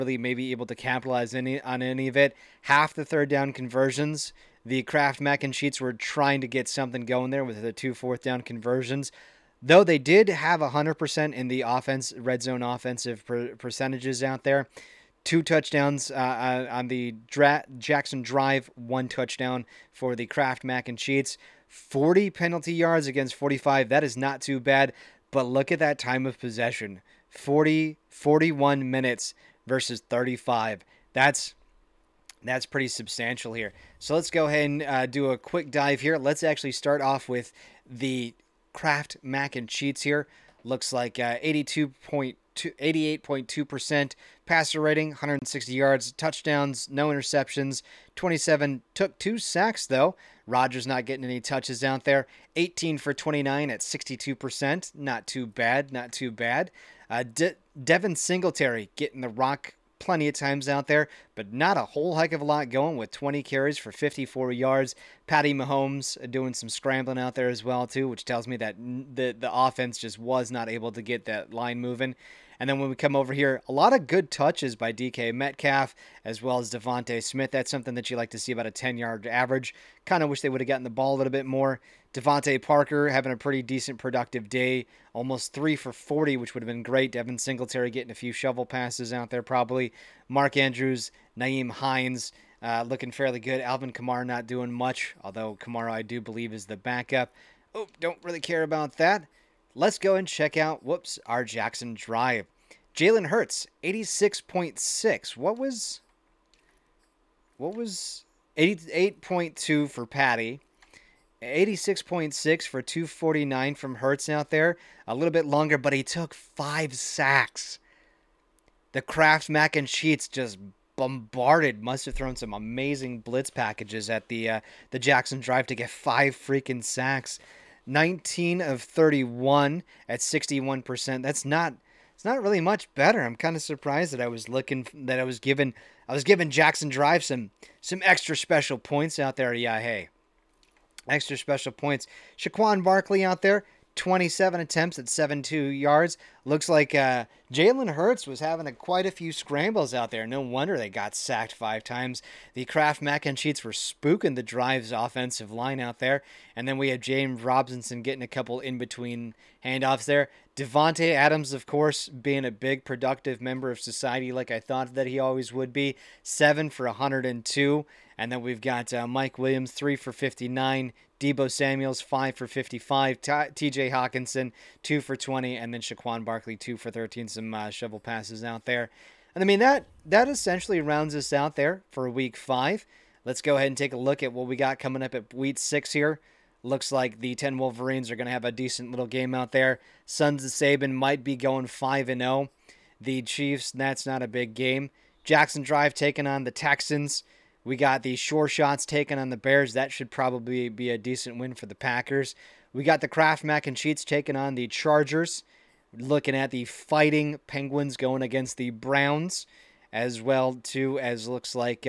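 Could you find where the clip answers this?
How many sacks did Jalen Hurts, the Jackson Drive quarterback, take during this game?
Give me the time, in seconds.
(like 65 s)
116 s.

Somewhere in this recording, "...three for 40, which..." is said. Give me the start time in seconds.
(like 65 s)
85 s.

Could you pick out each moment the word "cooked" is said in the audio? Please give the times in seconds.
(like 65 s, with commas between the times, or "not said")
not said.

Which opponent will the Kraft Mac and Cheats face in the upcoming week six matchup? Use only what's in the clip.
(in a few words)
Chargers.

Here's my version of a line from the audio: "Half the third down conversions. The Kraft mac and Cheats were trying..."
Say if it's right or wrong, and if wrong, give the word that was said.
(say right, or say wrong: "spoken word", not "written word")
right.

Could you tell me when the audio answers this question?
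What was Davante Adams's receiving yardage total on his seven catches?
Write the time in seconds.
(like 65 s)
166 s.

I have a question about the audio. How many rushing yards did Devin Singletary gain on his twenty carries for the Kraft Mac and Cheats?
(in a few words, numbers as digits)
54.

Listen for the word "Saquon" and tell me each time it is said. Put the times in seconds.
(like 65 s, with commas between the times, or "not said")
142 s, 175 s.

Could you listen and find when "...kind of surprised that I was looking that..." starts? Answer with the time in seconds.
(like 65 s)
133 s.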